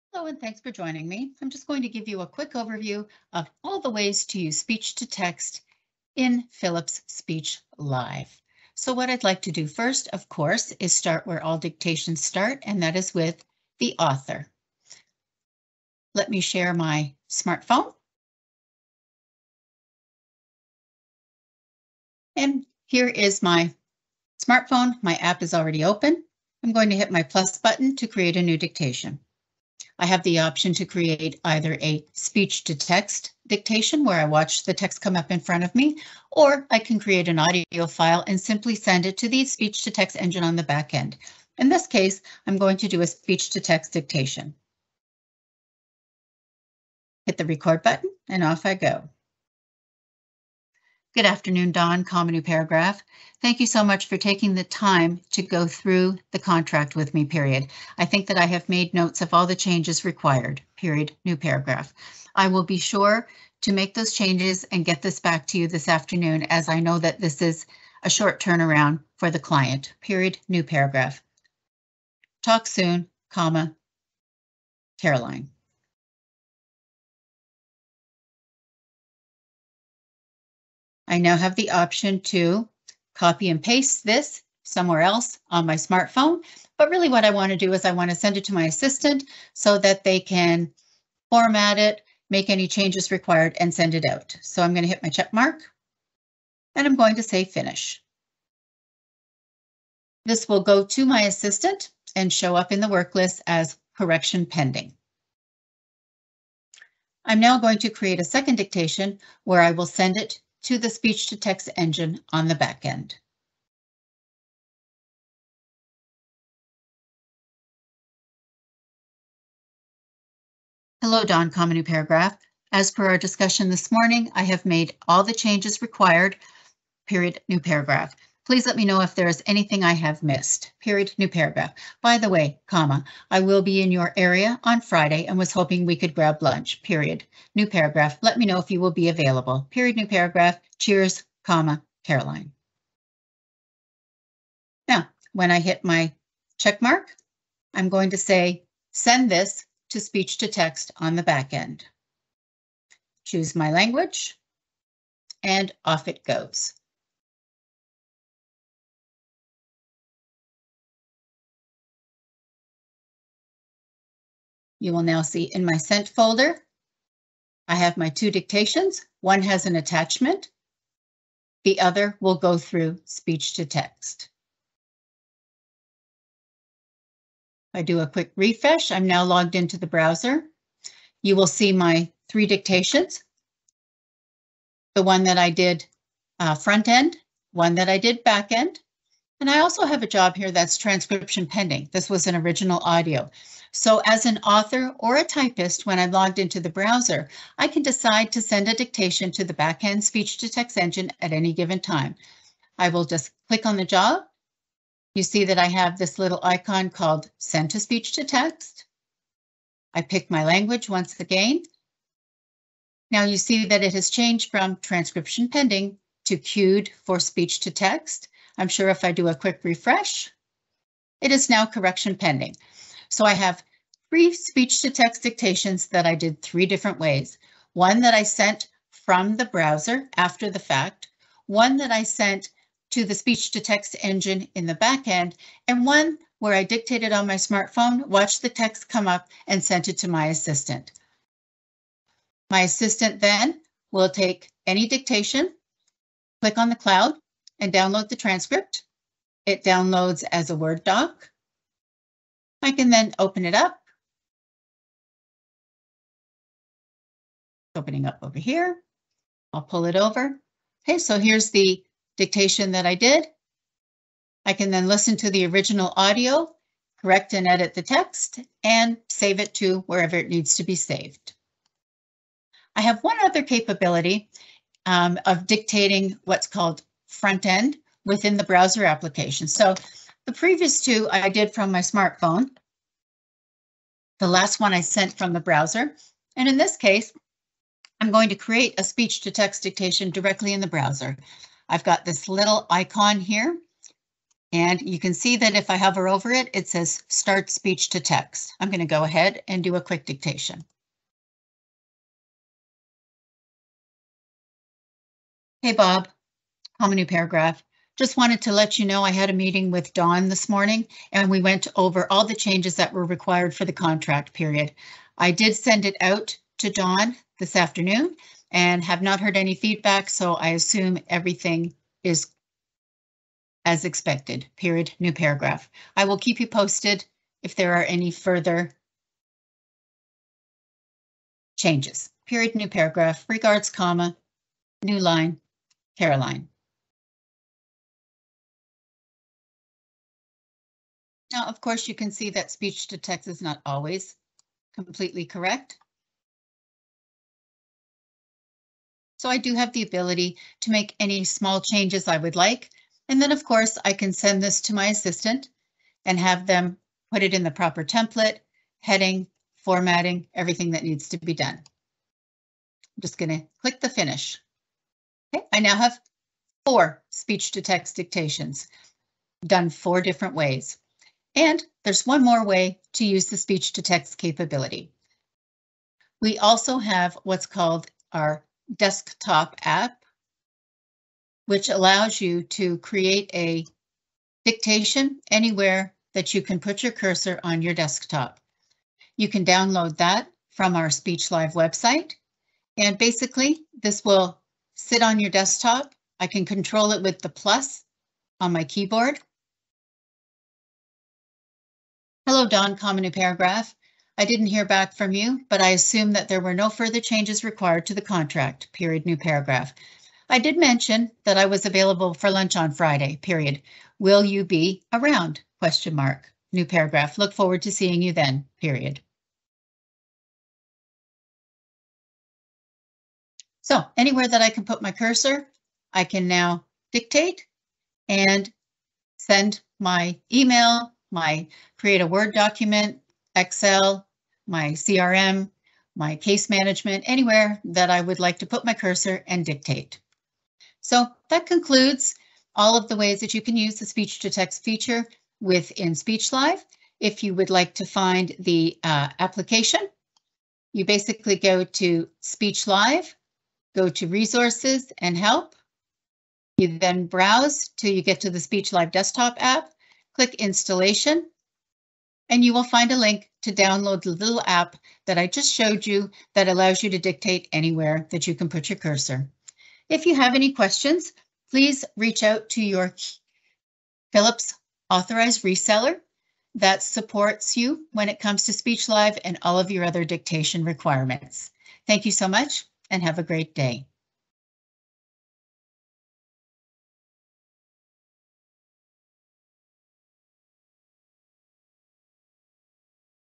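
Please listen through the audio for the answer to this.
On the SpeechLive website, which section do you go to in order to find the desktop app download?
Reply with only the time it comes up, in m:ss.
7:34.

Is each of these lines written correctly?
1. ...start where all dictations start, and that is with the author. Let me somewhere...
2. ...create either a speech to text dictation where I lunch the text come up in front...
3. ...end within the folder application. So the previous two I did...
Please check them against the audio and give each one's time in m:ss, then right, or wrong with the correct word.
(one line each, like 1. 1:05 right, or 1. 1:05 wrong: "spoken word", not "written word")
1. 0:10 wrong: "share", not "somewhere"
2. 0:30 wrong: "watch", not "lunch"
3. 4:37 wrong: "browser", not "folder".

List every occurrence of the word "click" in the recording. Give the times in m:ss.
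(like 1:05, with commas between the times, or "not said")
3:23, 4:06, 6:03, 7:40.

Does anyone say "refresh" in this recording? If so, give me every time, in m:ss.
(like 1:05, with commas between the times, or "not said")
2:58, 3:39.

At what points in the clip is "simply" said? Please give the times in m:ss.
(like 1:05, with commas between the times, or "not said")
0:38.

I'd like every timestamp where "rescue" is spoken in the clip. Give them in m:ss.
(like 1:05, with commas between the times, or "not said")
not said.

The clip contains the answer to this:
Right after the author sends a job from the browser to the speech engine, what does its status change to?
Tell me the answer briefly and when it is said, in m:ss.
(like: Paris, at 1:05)
queued for speech to text, at 3:36.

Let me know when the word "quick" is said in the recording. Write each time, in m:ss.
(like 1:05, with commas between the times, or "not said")
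0:02, 2:58, 3:39, 4:59.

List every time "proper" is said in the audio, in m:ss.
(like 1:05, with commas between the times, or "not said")
5:57.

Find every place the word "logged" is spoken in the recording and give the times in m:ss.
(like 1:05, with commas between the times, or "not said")
2:59, 3:16.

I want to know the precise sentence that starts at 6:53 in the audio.
Will you be around, question mark, new paragraph.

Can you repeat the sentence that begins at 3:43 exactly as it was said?
So I have three speech to text dictations that I did three different ways.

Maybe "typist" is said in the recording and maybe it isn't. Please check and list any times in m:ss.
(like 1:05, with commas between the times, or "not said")
3:15.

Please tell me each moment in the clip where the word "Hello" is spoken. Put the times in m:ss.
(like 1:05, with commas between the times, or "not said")
0:00, 2:01, 6:42.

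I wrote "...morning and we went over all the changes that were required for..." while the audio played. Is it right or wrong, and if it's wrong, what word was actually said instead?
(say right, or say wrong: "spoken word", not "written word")
right.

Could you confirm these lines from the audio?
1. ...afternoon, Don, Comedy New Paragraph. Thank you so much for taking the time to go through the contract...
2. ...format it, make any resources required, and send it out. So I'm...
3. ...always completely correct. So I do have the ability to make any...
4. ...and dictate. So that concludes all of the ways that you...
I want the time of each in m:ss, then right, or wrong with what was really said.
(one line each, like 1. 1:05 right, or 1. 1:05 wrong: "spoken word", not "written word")
1. 0:51 right
2. 1:31 wrong: "changes", not "resources"
3. 5:43 right
4. 7:19 right.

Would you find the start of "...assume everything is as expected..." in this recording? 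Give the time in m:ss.
5:20.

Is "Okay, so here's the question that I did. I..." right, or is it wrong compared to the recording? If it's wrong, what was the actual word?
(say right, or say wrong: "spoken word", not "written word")
wrong: "dictation", not "question".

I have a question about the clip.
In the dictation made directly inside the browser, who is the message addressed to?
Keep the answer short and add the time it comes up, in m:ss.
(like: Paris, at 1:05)
Bob, at 5:05.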